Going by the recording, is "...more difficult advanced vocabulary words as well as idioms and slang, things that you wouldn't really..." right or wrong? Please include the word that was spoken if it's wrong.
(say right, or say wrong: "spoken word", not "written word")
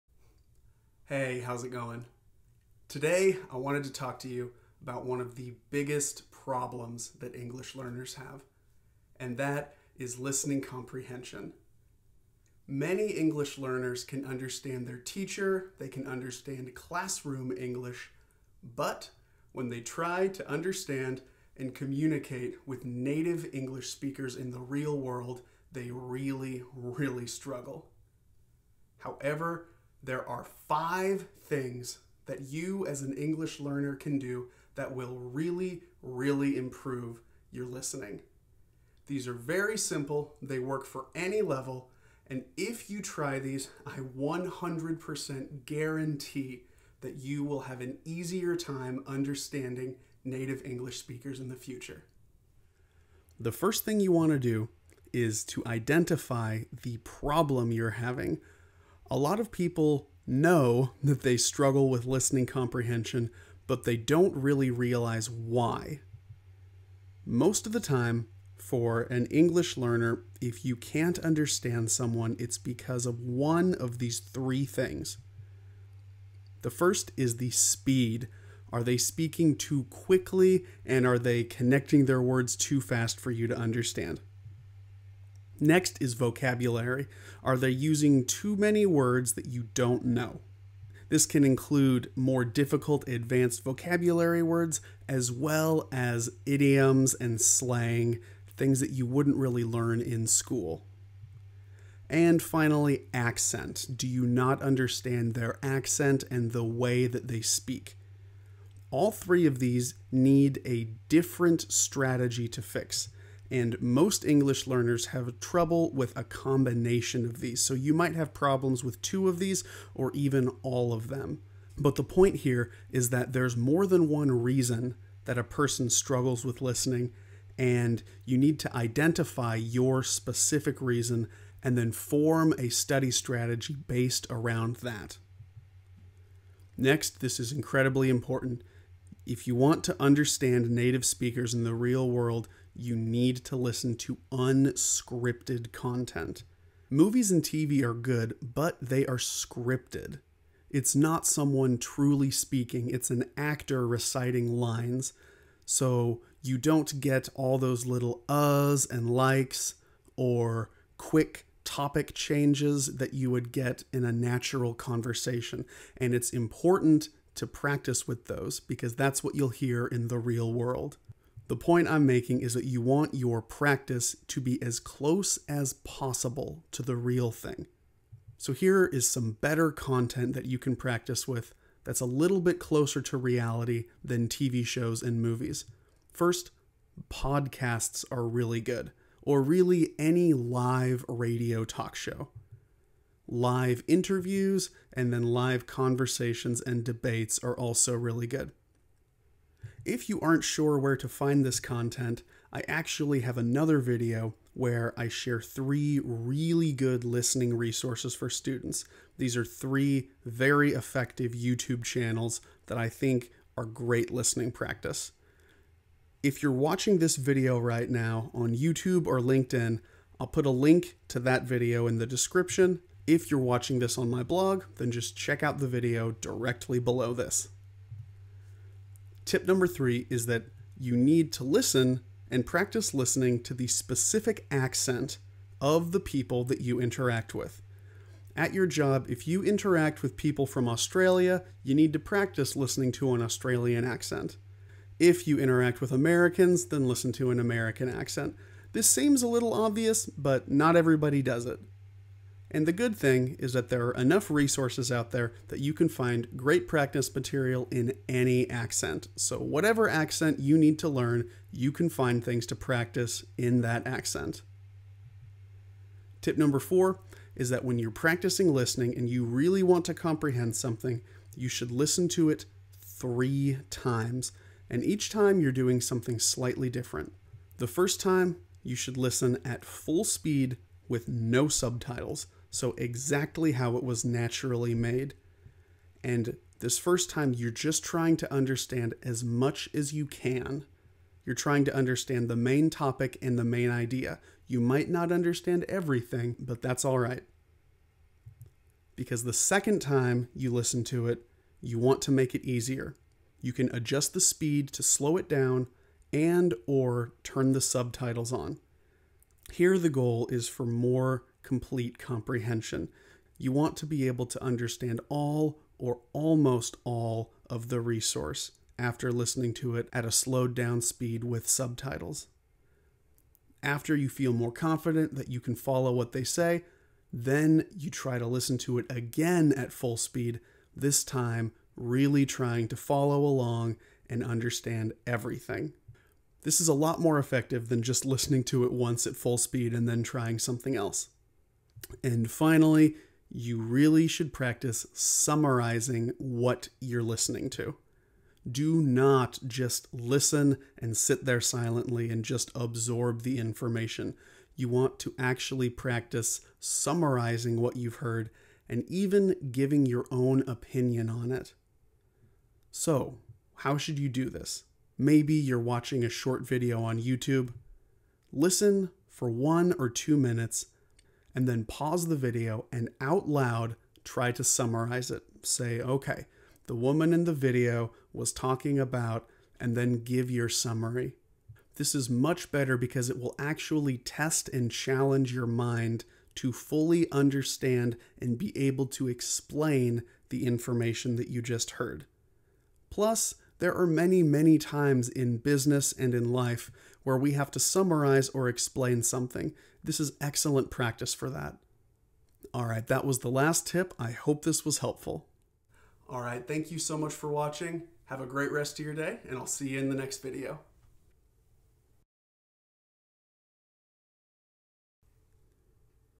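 right.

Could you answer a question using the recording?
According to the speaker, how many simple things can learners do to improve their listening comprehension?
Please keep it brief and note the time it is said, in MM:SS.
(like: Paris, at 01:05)
5, at 00:30.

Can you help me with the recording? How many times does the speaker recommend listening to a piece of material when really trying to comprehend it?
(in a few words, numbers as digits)
3.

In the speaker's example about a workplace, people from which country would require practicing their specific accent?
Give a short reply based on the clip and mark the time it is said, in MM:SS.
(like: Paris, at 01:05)
Australia, at 04:00.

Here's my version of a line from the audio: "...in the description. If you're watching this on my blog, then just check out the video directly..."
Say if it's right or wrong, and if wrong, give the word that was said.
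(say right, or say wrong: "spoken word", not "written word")
right.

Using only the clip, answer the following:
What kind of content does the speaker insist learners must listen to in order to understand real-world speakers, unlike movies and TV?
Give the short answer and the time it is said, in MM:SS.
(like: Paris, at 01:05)
Unscripted content, at 02:24.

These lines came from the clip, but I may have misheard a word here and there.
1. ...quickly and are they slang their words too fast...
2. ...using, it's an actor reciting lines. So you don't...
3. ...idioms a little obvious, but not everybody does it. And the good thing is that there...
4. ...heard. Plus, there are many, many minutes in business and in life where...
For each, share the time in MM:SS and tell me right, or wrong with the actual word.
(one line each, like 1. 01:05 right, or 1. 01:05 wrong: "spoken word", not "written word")
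1. 01:19 wrong: "connecting", not "slang"
2. 02:32 wrong: "speaking", not "using"
3. 04:08 wrong: "seems", not "idioms"
4. 06:31 wrong: "times", not "minutes".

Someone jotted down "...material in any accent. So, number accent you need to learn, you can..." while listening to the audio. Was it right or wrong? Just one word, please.
wrong.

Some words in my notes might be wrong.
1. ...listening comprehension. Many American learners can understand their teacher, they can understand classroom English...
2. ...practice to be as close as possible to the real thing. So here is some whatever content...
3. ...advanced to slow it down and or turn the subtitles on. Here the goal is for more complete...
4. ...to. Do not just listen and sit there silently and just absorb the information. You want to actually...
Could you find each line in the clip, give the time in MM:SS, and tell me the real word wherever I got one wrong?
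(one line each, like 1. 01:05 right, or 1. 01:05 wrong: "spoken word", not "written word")
1. 00:10 wrong: "English", not "American"
2. 02:53 wrong: "better", not "whatever"
3. 05:04 wrong: "speed", not "advanced"
4. 05:47 right.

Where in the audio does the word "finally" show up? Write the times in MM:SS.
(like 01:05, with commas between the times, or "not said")
01:42, 05:42.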